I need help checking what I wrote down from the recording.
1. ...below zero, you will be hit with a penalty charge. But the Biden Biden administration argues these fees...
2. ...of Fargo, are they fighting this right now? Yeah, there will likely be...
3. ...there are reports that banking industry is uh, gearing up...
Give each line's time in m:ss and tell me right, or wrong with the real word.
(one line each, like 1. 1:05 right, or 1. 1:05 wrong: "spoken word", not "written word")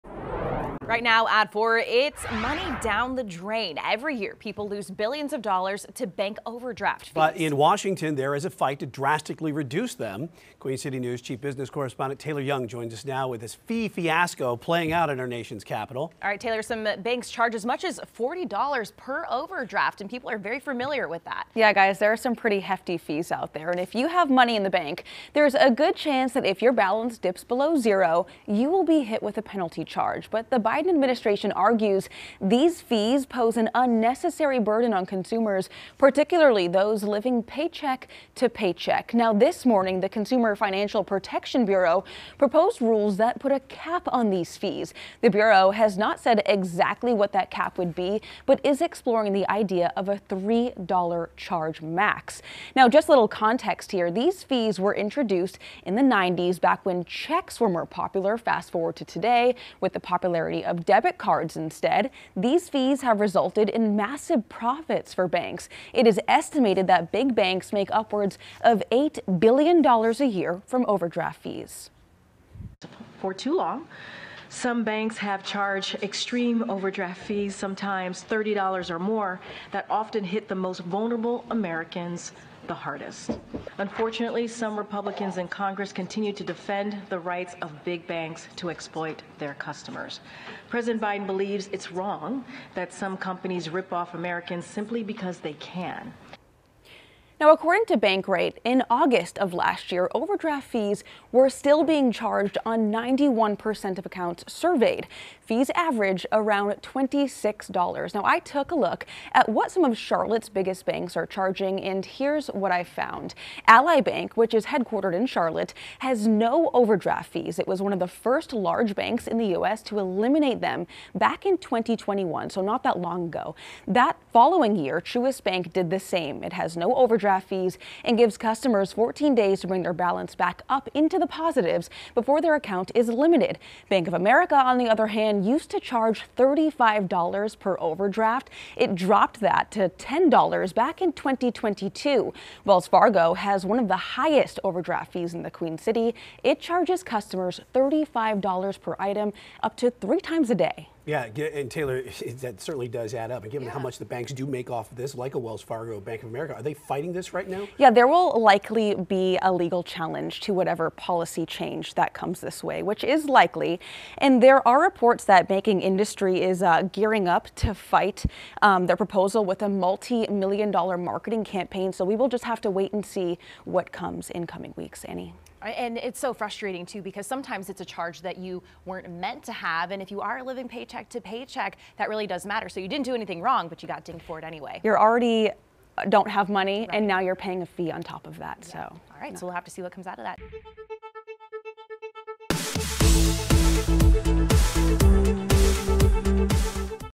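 1. 0:27 right
2. 2:36 wrong: "America", not "Fargo"
3. 2:44 right.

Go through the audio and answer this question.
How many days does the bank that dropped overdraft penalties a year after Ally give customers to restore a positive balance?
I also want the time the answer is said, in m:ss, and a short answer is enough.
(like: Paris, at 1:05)
14, at 2:08.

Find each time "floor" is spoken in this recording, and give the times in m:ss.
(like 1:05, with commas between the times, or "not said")
not said.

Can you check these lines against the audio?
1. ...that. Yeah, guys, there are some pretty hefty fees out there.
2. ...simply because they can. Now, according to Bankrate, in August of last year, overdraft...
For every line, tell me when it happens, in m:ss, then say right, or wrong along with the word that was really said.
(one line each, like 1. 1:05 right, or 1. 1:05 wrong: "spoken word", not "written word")
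1. 0:21 right
2. 1:34 right.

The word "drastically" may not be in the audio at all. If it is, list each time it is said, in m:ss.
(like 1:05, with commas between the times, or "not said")
0:08.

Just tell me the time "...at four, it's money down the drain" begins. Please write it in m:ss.
0:01.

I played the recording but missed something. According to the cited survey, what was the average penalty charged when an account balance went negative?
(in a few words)
$26.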